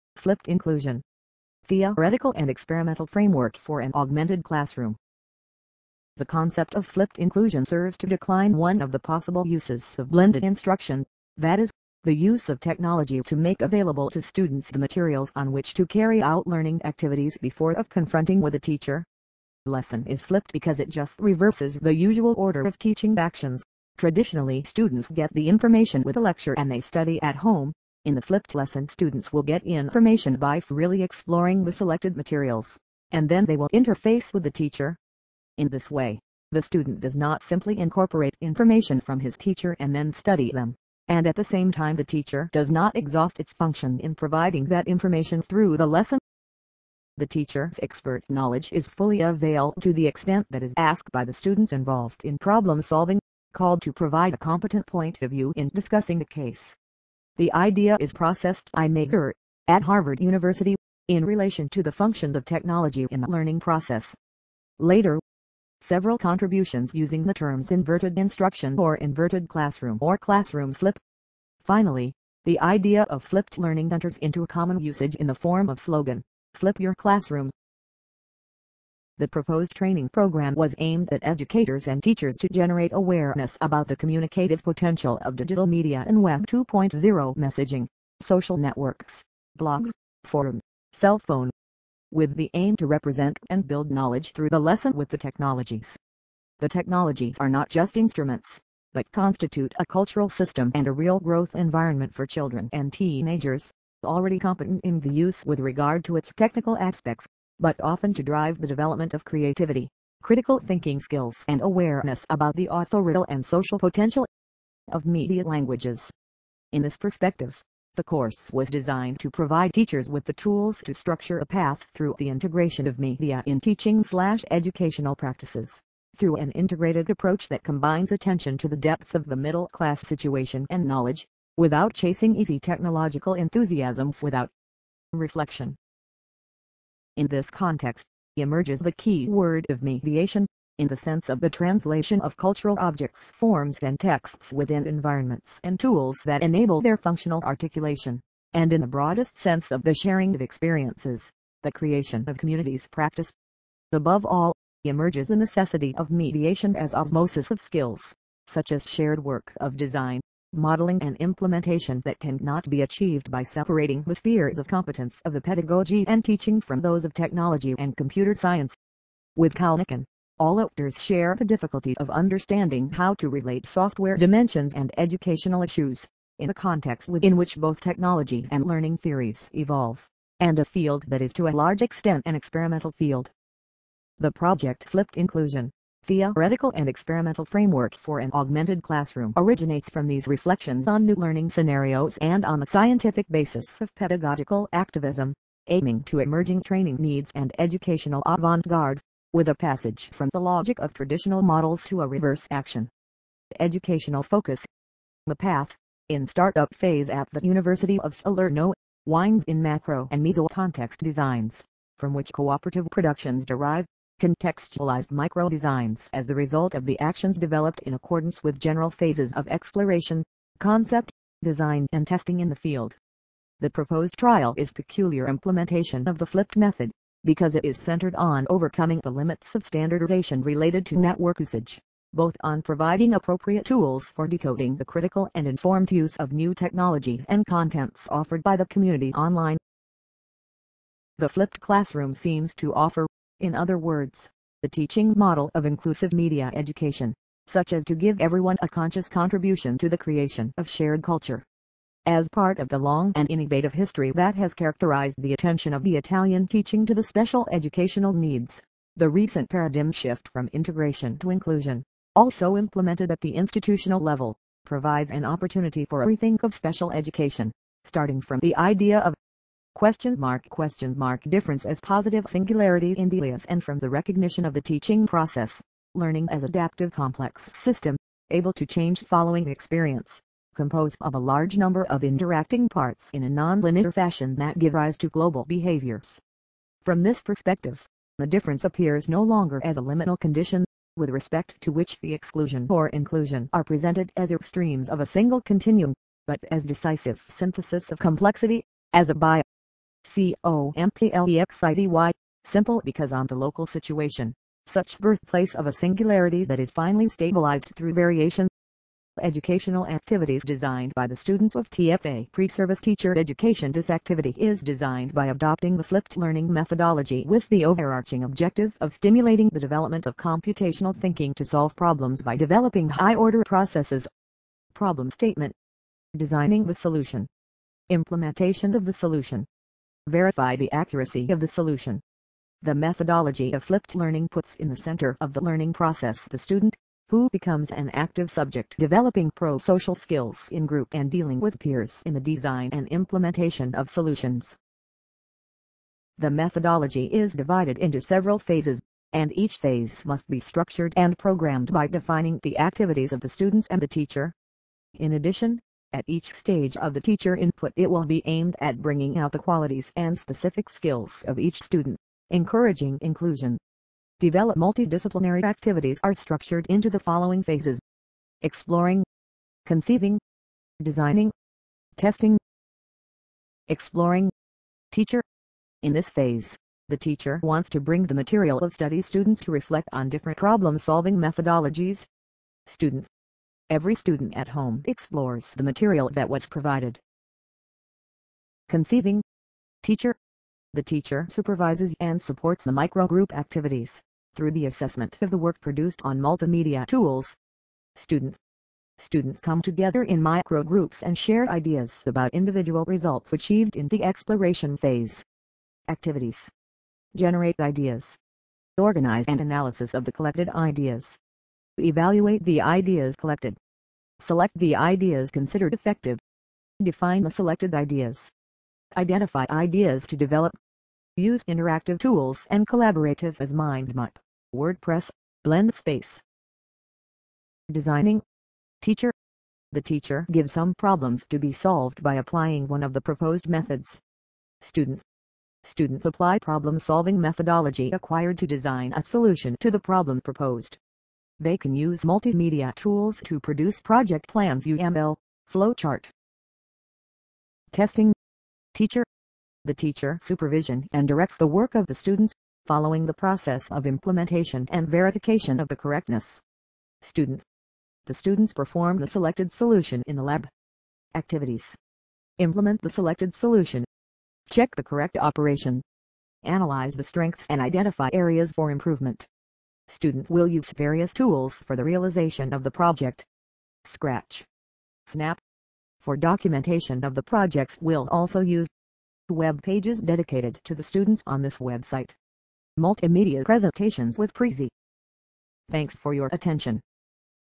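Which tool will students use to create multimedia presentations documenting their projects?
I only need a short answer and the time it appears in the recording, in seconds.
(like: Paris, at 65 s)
Prezi, at 484 s.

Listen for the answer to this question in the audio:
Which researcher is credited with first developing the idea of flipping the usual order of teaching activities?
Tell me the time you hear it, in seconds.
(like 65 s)
58 s.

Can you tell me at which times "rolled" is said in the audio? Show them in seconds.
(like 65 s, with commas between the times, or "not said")
not said.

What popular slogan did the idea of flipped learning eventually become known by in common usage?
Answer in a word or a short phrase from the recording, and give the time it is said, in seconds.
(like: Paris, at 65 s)
Flip your classroom, at 76 s.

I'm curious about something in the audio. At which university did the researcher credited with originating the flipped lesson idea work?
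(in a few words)
Harvard University.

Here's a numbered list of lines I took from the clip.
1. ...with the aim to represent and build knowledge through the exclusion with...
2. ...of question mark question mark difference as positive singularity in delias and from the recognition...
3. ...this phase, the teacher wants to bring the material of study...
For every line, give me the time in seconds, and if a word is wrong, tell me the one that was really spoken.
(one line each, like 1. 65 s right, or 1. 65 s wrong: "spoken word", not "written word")
1. 92 s wrong: "lesson", not "exclusion"
2. 268 s right
3. 375 s right.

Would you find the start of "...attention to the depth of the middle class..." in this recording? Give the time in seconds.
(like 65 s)
128 s.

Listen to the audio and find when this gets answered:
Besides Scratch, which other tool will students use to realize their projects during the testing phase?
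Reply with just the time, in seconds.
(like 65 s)
475 s.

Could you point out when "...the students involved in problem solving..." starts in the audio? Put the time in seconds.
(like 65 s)
51 s.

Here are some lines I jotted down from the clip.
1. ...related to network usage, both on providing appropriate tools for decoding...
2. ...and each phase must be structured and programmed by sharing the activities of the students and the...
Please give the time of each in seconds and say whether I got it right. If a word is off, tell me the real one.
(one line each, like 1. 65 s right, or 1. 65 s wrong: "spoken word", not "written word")
1. 230 s right
2. 349 s wrong: "defining", not "sharing".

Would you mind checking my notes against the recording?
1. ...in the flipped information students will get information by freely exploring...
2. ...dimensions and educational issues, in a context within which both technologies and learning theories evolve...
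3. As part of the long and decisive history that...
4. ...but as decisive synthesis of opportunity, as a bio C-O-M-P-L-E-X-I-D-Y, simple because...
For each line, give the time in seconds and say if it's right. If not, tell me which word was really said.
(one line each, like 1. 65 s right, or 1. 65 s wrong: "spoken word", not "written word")
1. 28 s wrong: "lesson", not "information"
2. 174 s right
3. 252 s wrong: "innovative", not "decisive"
4. 296 s wrong: "complexity", not "opportunity".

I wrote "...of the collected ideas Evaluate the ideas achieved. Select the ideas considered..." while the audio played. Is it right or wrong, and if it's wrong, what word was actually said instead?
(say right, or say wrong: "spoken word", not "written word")
wrong: "collected", not "achieved".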